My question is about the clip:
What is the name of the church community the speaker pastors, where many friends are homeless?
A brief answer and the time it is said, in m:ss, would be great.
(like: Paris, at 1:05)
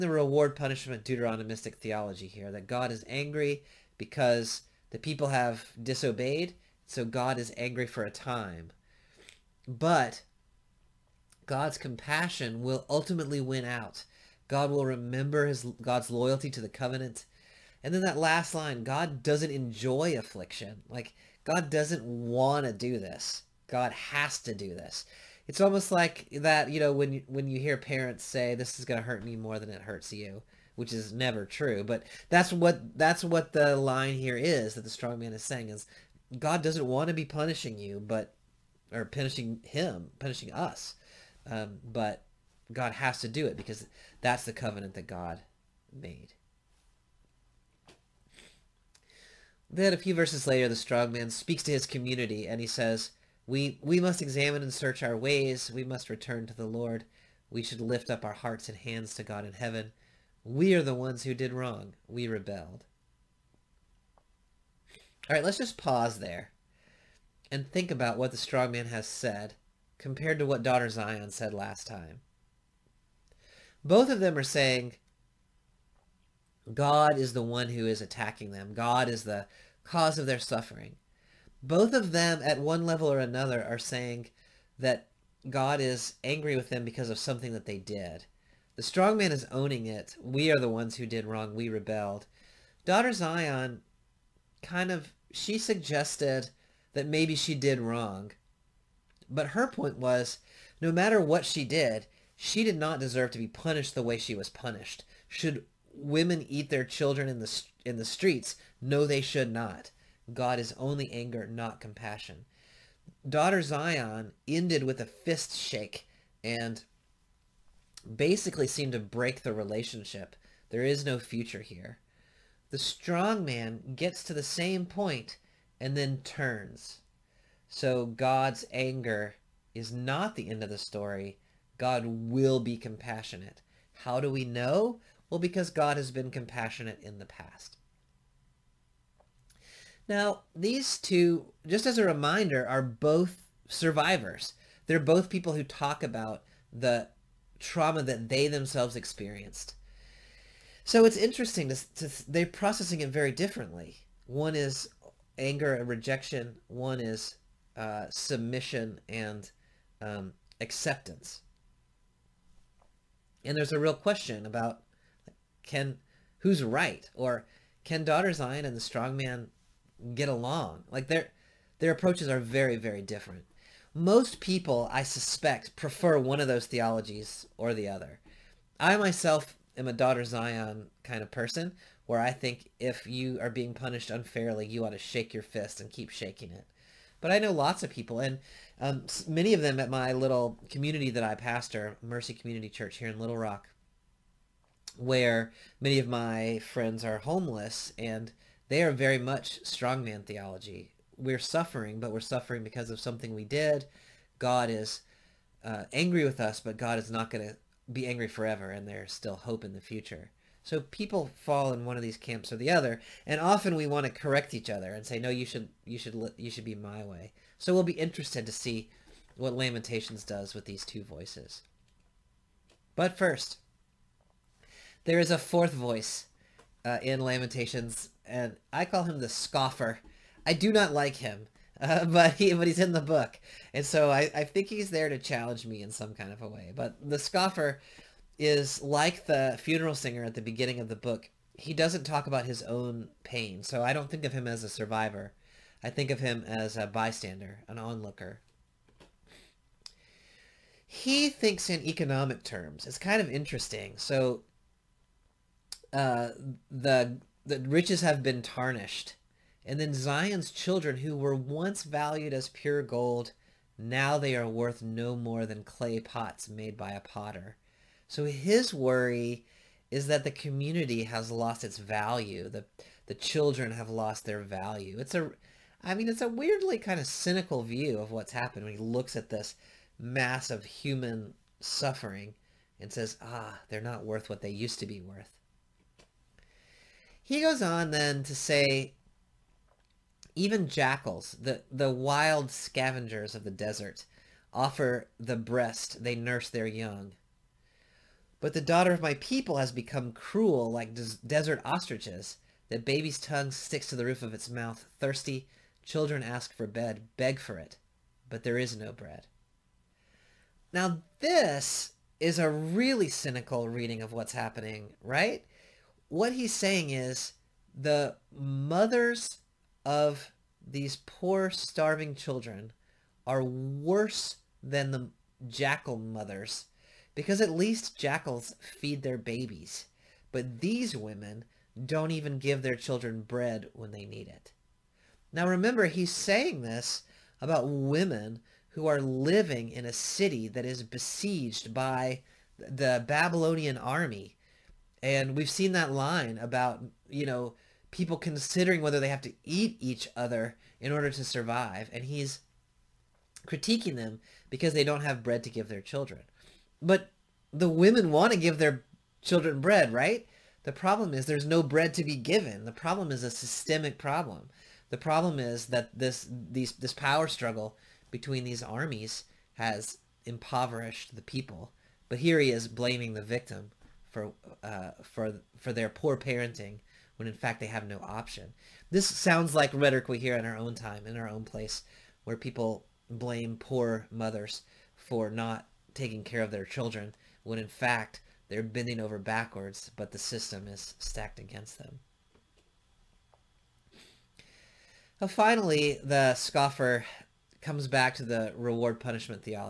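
Mercy Community Church, at 3:12.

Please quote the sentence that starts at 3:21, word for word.
We're suffering, but we're suffering because of something we did.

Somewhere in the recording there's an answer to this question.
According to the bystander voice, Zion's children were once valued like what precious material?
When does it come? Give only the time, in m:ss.
4:22.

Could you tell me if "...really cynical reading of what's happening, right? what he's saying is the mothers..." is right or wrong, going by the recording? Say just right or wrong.
right.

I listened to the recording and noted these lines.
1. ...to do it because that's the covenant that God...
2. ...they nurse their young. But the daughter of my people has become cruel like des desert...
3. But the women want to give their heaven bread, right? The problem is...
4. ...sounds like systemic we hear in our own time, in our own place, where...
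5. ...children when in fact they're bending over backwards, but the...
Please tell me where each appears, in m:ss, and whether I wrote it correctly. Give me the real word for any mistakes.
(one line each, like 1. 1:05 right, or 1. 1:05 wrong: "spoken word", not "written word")
1. 0:43 right
2. 4:56 right
3. 5:56 wrong: "children", not "heaven"
4. 6:19 wrong: "rhetoric", not "systemic"
5. 6:26 right.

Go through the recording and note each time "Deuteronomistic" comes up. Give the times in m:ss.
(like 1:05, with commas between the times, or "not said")
0:01.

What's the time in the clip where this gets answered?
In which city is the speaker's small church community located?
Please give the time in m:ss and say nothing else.
3:13.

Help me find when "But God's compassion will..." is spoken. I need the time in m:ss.
0:09.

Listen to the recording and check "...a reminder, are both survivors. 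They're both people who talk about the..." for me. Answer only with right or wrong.
right.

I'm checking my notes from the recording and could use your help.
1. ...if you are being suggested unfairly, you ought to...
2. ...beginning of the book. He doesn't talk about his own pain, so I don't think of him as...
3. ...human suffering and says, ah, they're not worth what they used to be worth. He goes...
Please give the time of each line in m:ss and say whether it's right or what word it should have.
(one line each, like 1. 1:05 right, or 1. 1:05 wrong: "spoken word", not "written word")
1. 3:02 wrong: "punished", not "suggested"
2. 4:00 right
3. 4:40 right.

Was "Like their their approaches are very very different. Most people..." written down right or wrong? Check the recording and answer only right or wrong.
right.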